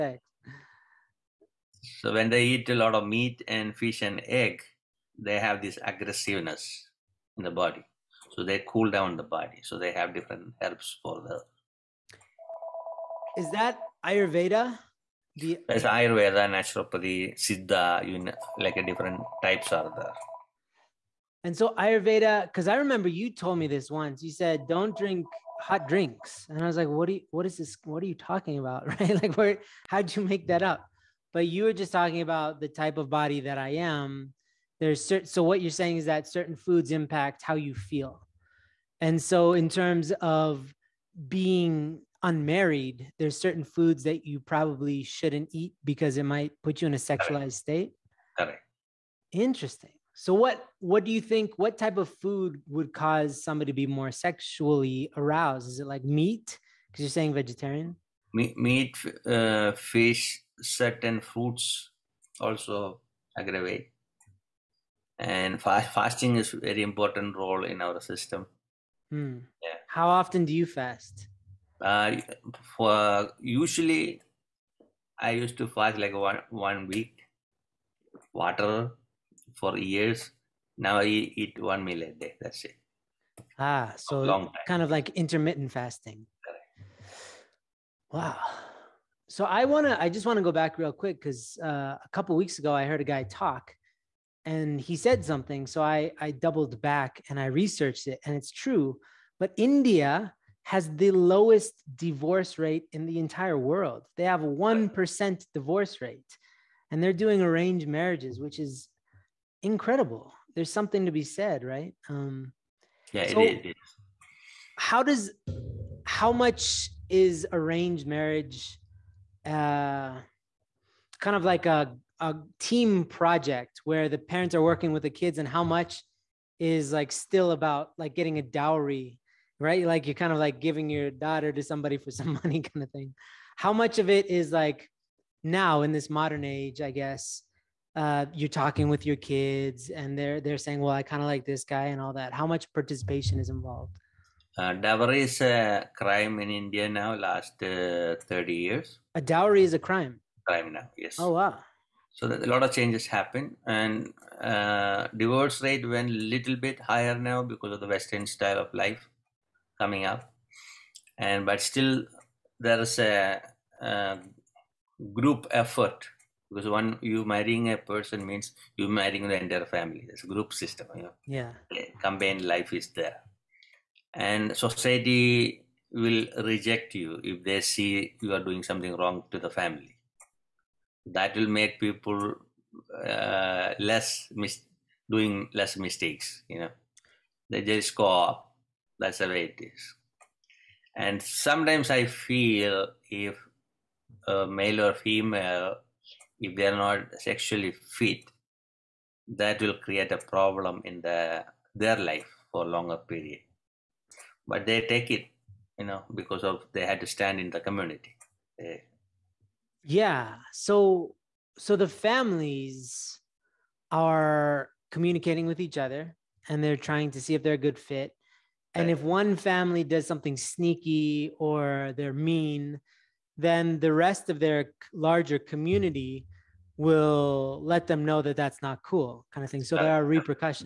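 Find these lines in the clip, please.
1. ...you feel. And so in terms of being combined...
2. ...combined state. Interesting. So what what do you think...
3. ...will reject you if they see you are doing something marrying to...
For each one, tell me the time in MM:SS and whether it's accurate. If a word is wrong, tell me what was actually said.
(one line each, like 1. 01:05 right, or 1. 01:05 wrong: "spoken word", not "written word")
1. 00:37 wrong: "unmarried", not "combined"
2. 00:46 wrong: "sexualized", not "combined"
3. 02:55 wrong: "wrong", not "marrying".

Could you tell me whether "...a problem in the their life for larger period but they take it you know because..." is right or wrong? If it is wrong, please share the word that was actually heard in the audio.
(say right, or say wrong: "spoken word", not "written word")
wrong: "longer", not "larger".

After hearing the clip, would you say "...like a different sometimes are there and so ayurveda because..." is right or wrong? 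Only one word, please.
wrong.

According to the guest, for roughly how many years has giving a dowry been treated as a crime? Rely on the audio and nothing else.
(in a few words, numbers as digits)
30 years.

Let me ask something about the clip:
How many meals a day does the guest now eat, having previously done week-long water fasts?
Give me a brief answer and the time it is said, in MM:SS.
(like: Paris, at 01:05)
1, at 01:21.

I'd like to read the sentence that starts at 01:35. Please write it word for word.
So I, I doubled back and I researched it, and it's true.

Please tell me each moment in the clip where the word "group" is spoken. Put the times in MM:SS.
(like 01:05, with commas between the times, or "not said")
02:45, 02:50.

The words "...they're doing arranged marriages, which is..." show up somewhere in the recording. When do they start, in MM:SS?
01:47.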